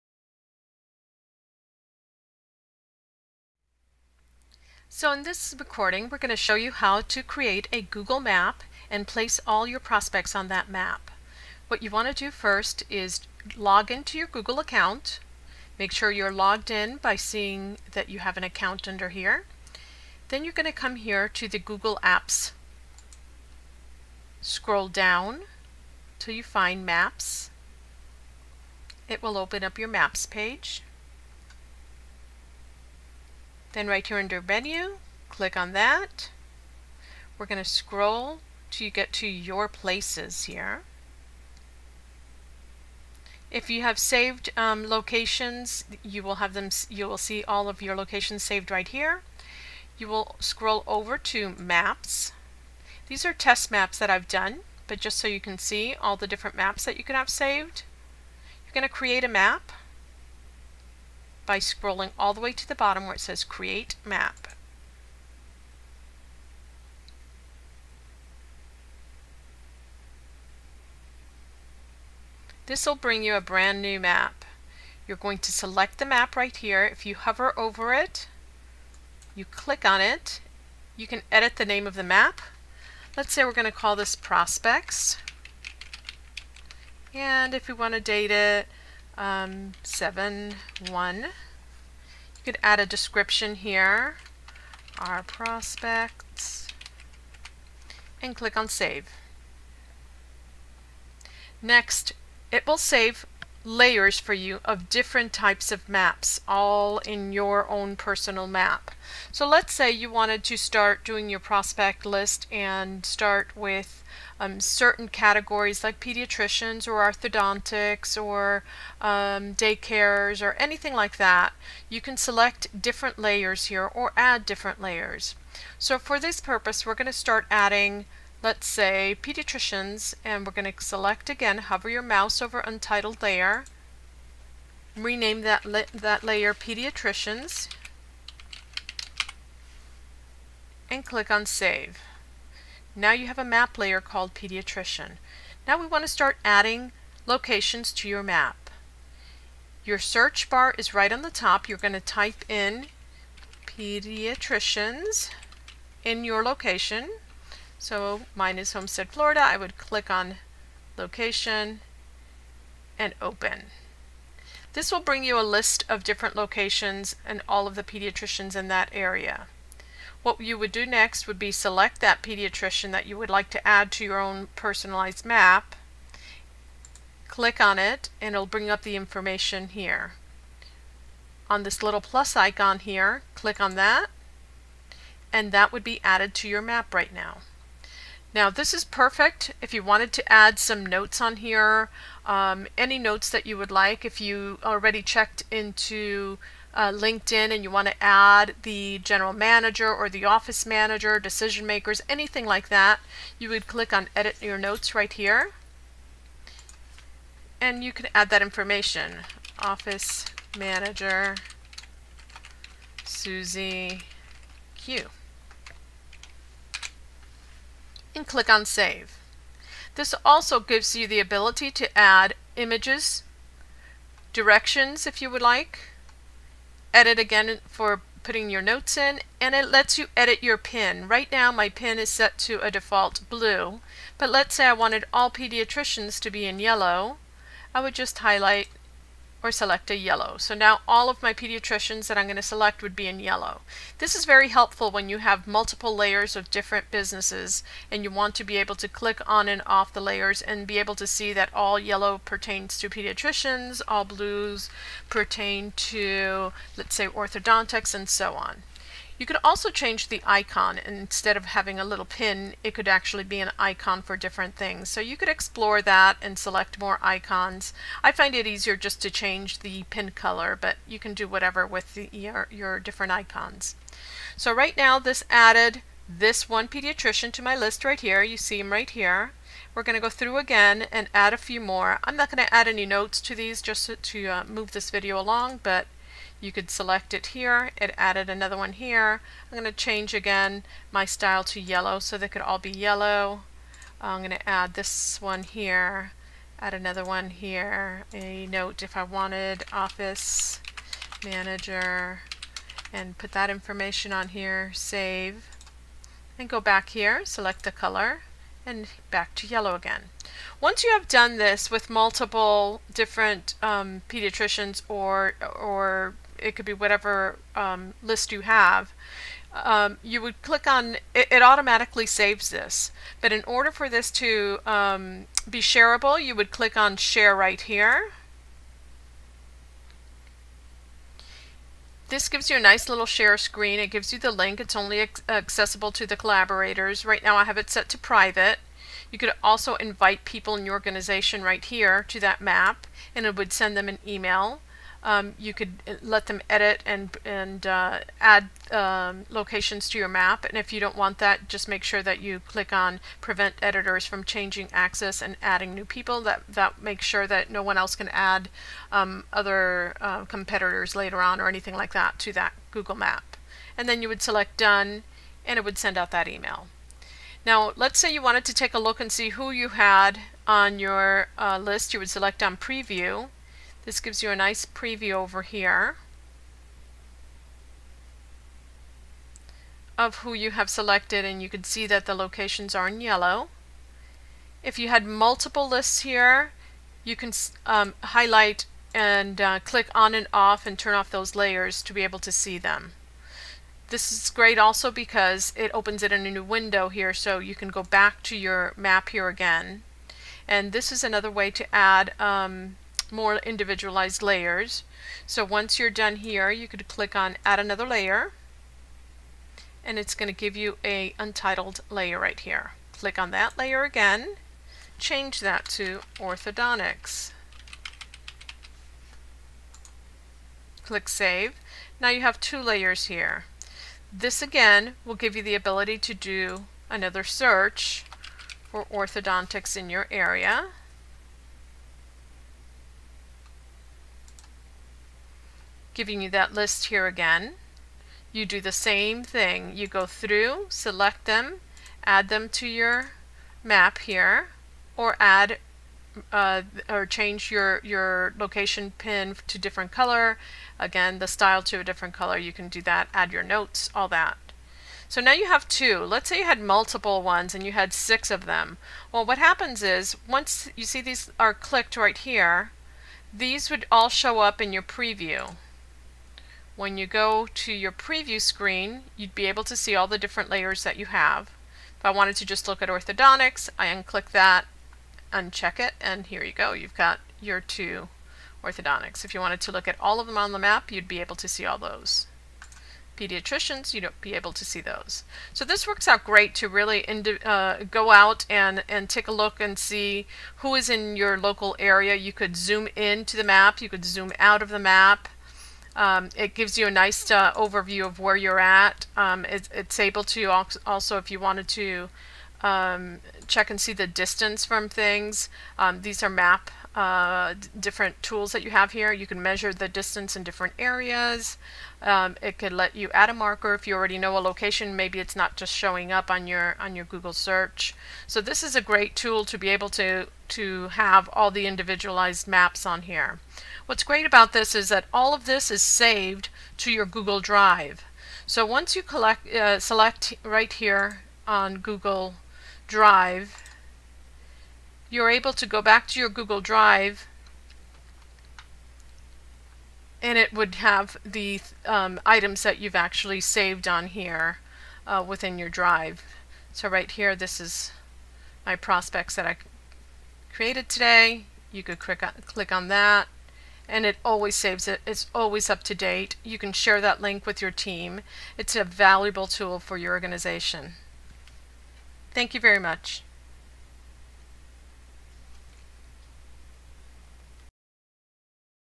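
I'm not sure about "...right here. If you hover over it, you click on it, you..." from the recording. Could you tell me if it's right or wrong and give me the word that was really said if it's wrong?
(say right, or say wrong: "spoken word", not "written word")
right.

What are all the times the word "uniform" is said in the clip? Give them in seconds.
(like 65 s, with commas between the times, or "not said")
not said.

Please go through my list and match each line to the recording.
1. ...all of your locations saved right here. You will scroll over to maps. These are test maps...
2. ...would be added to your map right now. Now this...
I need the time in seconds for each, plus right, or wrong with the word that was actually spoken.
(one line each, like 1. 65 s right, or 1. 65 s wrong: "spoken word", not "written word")
1. 47 s right
2. 185 s right.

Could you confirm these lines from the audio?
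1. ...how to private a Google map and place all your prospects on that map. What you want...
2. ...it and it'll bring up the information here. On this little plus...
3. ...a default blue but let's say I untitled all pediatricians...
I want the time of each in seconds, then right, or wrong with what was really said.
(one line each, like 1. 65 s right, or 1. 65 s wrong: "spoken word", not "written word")
1. 6 s wrong: "create", not "private"
2. 177 s right
3. 232 s wrong: "wanted", not "untitled".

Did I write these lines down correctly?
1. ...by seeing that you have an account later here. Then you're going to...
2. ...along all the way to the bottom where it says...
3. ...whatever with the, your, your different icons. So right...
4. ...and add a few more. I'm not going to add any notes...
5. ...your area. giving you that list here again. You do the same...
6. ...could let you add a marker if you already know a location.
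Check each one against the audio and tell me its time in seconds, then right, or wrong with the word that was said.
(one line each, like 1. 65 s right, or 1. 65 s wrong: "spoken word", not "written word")
1. 16 s wrong: "under", not "later"
2. 61 s wrong: "scrolling", not "along"
3. 271 s right
4. 280 s right
5. 429 s right
6. 512 s right.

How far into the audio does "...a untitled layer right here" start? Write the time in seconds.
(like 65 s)
410 s.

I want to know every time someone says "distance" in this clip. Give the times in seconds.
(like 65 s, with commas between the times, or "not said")
504 s, 509 s.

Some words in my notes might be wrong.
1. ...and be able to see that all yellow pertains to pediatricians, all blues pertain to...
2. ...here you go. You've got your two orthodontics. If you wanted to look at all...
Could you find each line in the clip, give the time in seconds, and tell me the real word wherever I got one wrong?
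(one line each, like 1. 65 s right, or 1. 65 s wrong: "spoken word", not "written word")
1. 250 s right
2. 476 s right.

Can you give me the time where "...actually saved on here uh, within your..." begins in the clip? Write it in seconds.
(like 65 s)
542 s.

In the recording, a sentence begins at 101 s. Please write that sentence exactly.
Next, it will save layers for you of different types of maps, all in your own personal map.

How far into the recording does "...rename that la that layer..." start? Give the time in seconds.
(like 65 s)
134 s.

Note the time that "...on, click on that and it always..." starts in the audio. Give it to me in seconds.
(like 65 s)
552 s.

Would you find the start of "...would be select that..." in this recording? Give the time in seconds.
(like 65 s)
171 s.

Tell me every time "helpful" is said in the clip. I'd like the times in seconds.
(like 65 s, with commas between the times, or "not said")
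244 s.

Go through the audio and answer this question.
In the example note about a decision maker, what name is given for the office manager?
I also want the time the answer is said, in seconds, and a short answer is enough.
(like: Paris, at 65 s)
Susie Q, at 213 s.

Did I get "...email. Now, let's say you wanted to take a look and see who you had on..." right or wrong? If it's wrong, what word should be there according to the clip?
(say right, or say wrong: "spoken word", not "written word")
right.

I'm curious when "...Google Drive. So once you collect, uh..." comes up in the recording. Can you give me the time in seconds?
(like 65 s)
527 s.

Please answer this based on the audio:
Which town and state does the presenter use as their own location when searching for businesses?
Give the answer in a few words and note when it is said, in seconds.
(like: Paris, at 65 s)
Homestead, Florida, at 158 s.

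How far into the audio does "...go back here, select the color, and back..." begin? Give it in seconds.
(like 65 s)
306 s.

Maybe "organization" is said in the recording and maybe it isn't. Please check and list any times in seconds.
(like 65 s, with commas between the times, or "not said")
340 s, 560 s.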